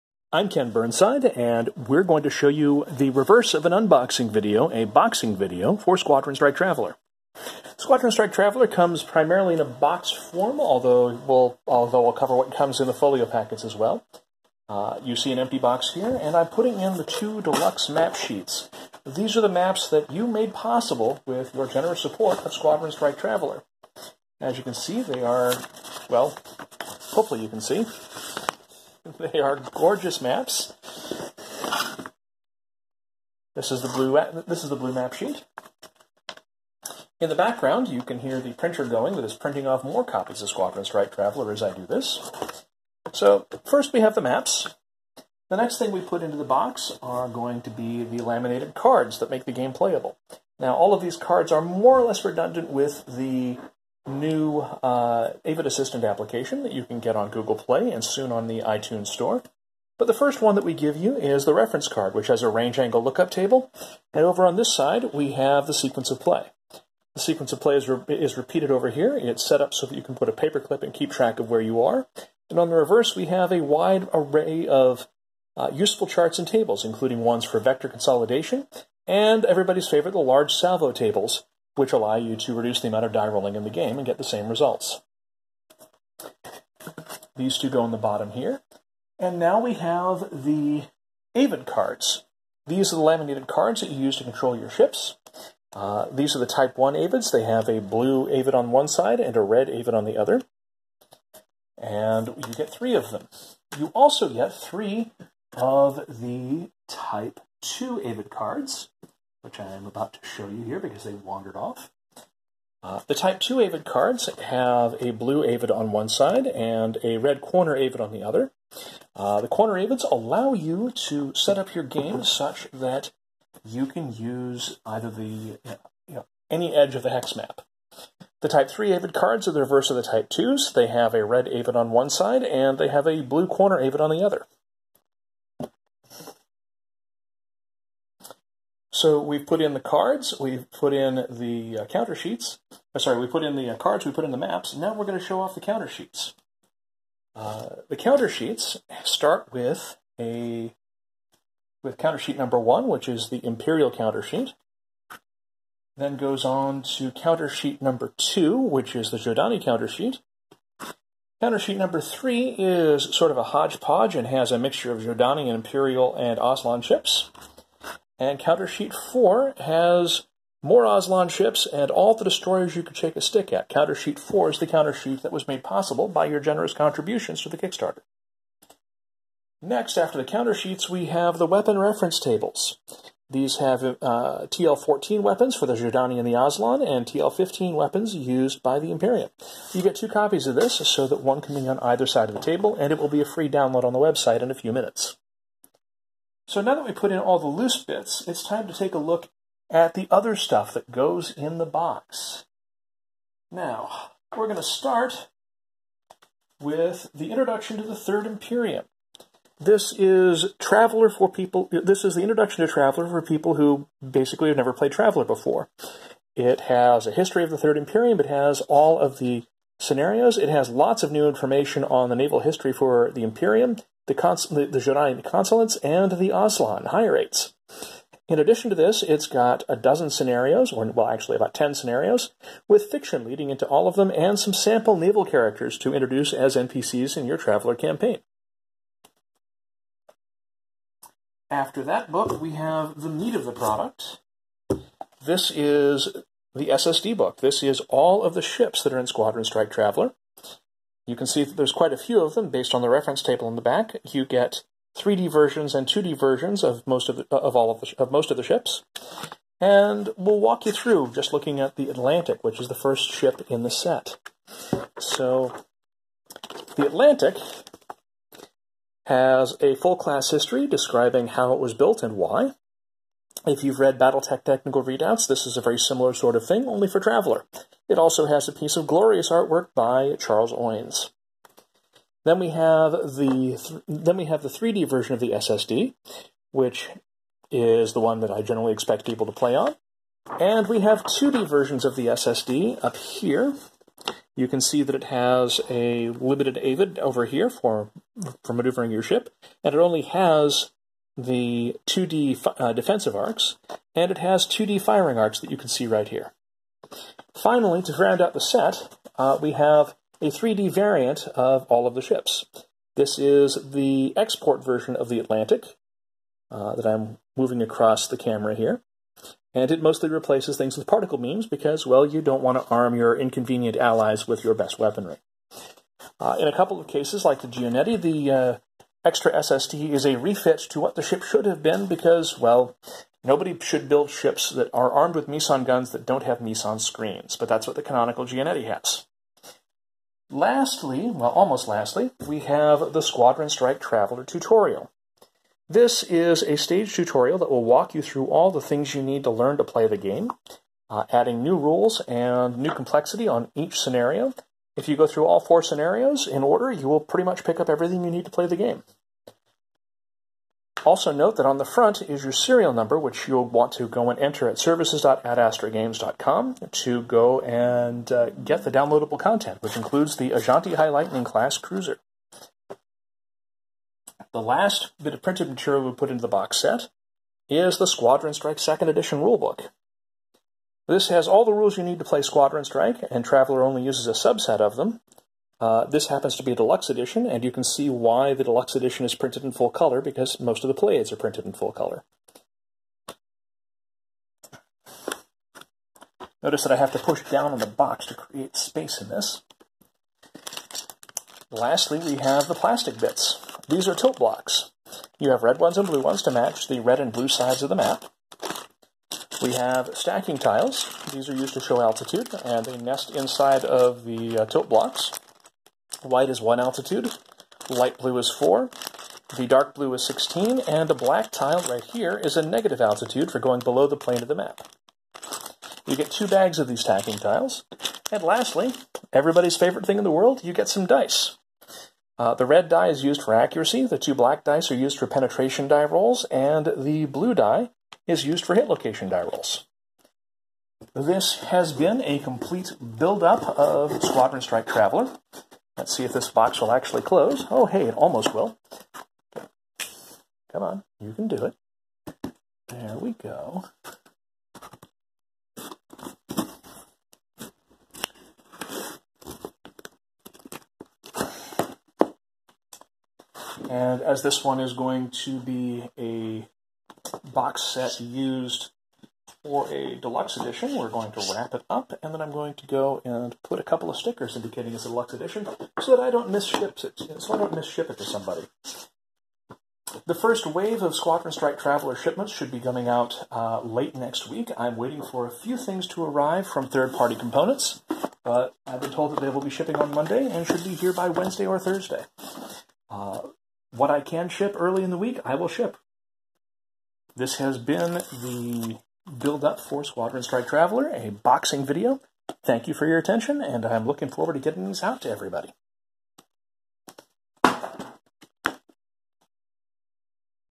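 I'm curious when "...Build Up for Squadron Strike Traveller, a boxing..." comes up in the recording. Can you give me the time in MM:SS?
08:19.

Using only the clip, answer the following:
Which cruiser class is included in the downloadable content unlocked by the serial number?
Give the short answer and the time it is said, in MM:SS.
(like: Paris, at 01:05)
Azhanti High Lightning, at 06:10.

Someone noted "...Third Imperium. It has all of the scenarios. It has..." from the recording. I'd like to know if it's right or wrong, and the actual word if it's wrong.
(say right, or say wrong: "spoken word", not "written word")
right.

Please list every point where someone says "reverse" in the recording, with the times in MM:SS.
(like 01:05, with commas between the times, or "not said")
00:03, 01:12, 02:09.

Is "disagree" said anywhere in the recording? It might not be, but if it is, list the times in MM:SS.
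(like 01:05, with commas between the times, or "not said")
not said.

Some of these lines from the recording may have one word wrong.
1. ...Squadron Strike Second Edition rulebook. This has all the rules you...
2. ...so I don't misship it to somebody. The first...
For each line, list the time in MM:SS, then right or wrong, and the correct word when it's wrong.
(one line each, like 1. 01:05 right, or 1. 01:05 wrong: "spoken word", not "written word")
1. 06:17 right
2. 07:57 right.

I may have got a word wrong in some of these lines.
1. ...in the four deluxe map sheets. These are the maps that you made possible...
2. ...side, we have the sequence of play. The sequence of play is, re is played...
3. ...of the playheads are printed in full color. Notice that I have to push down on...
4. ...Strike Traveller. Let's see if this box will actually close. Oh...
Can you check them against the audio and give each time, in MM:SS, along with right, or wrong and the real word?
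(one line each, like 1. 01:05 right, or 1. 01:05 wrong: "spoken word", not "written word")
1. 00:16 wrong: "two", not "four"
2. 01:04 wrong: "repeated", not "played"
3. 06:30 right
4. 07:24 right.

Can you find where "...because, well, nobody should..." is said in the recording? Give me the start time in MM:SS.
05:31.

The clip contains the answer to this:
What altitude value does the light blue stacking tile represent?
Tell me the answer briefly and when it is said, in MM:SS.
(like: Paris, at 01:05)
4, at 06:57.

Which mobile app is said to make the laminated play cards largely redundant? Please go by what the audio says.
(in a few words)
Avid Assistant.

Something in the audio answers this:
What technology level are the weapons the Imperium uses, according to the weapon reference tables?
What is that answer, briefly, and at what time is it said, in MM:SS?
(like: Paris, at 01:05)
TL-15, at 03:07.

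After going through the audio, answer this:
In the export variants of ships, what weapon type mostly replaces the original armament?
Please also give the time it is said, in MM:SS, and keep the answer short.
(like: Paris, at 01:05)
Particle beams, at 05:20.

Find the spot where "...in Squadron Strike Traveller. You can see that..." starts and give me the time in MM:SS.
04:08.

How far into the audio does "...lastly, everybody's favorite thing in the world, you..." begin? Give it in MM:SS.
07:08.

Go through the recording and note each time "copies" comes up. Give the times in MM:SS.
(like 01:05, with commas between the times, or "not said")
00:40, 03:10.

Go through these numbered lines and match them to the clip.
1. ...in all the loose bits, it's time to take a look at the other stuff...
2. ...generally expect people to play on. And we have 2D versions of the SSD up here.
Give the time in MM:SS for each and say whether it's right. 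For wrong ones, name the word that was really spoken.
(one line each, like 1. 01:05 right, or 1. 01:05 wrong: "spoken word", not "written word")
1. 03:17 right
2. 04:48 right.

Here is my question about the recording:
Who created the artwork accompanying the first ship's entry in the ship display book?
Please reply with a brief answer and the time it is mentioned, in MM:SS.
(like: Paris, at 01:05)
Charles Oines, at 04:40.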